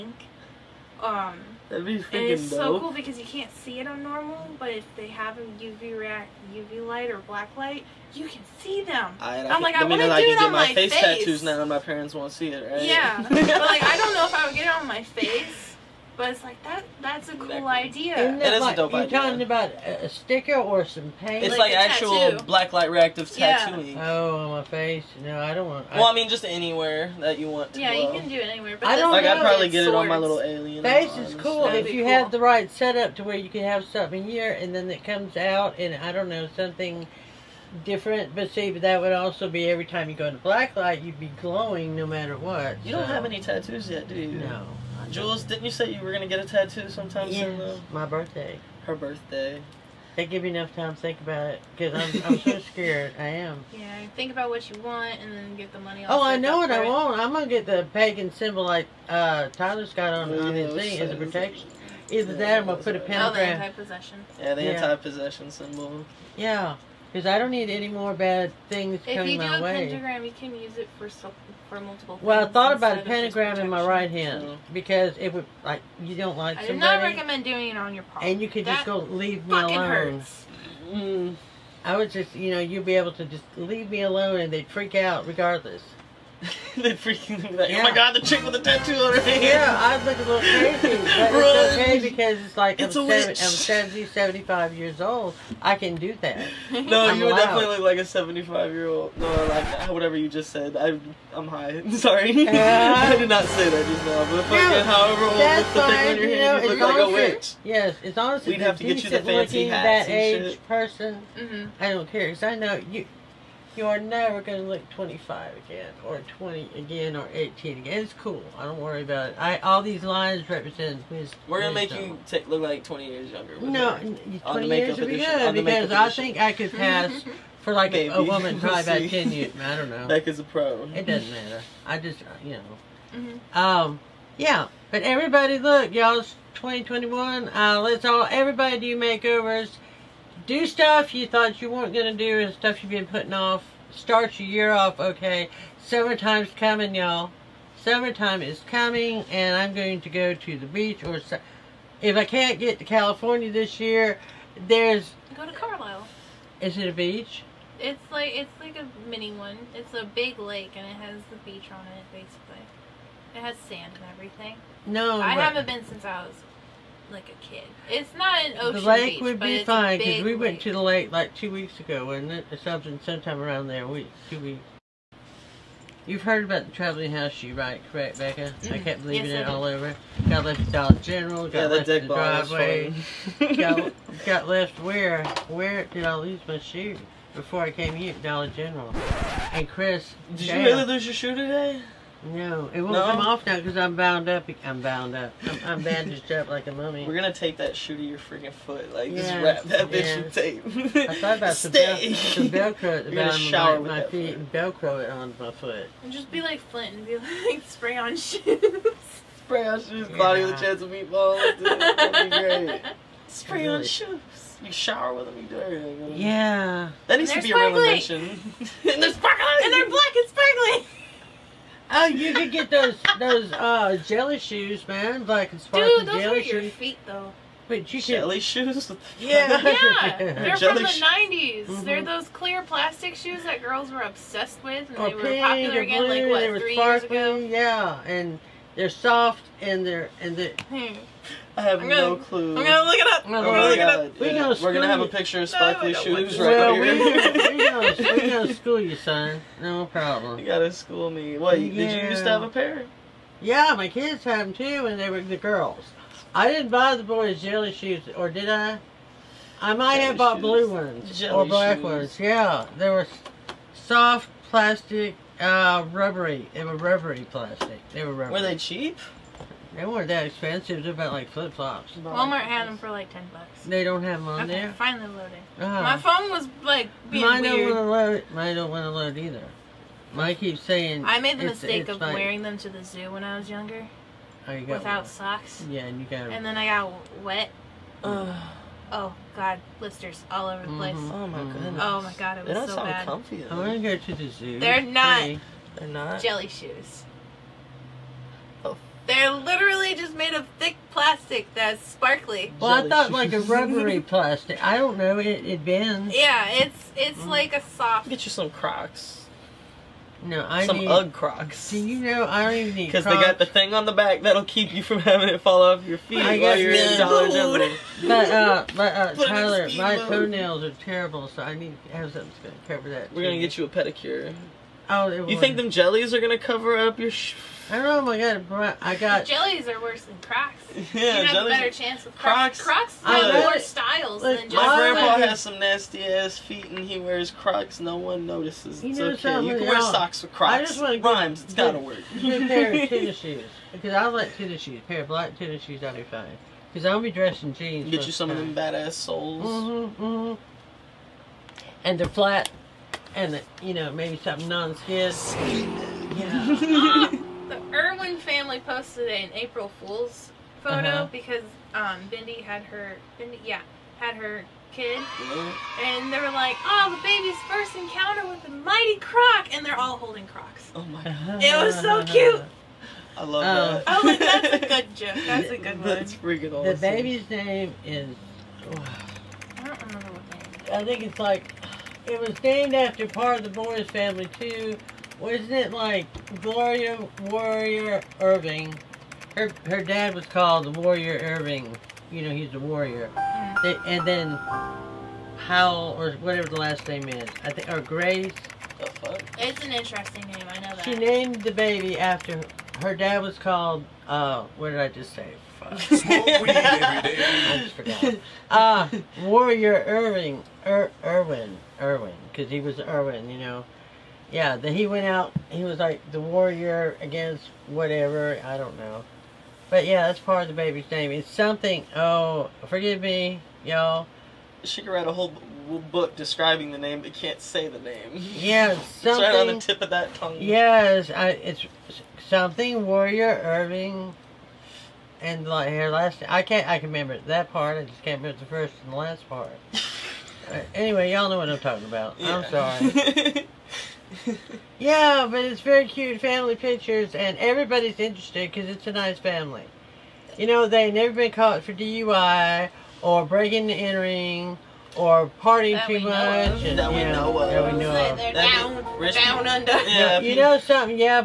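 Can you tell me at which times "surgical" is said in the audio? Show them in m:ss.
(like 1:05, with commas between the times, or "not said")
not said.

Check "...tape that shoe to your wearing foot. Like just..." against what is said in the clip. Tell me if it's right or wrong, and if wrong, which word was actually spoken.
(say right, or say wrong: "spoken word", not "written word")
wrong: "freaking", not "wearing".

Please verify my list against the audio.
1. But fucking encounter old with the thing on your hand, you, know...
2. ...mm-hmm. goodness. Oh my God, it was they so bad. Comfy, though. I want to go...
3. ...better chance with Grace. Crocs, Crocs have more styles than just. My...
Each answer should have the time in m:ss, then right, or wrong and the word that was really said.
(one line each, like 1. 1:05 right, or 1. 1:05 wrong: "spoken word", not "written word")
1. 1:44 wrong: "however", not "encounter"
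2. 4:51 right
3. 5:31 wrong: "Crocs", not "Grace".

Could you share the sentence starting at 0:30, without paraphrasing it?
Face is cool That'd if you cool.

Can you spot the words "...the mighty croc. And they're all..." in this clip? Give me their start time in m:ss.
6:08.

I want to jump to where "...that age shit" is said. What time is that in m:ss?
1:50.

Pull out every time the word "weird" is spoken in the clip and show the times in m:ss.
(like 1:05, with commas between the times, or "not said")
4:37.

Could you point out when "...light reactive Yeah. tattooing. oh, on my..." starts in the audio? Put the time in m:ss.
0:22.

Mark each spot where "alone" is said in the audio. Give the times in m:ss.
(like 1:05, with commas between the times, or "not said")
1:19, 1:24.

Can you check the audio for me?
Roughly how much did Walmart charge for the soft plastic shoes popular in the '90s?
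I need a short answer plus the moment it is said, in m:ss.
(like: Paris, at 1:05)
$10, at 4:33.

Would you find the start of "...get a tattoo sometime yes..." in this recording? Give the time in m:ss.
0:46.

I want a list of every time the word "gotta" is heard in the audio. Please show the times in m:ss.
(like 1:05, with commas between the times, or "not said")
4:10, 5:41.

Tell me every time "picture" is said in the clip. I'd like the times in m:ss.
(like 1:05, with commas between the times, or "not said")
4:05, 7:26.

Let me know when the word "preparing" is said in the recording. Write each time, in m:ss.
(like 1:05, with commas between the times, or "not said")
not said.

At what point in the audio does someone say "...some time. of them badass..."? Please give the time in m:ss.
5:48.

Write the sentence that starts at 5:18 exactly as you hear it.
But uh, but uh, Tyler, my mode.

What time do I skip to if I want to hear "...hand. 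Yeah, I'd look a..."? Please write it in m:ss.
1:29.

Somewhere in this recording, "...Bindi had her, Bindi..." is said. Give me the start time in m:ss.
6:02.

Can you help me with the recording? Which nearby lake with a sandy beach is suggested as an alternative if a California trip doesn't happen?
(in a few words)
Carlyle.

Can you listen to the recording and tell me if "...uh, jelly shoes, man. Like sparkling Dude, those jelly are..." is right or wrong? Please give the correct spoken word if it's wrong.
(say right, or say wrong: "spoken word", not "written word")
right.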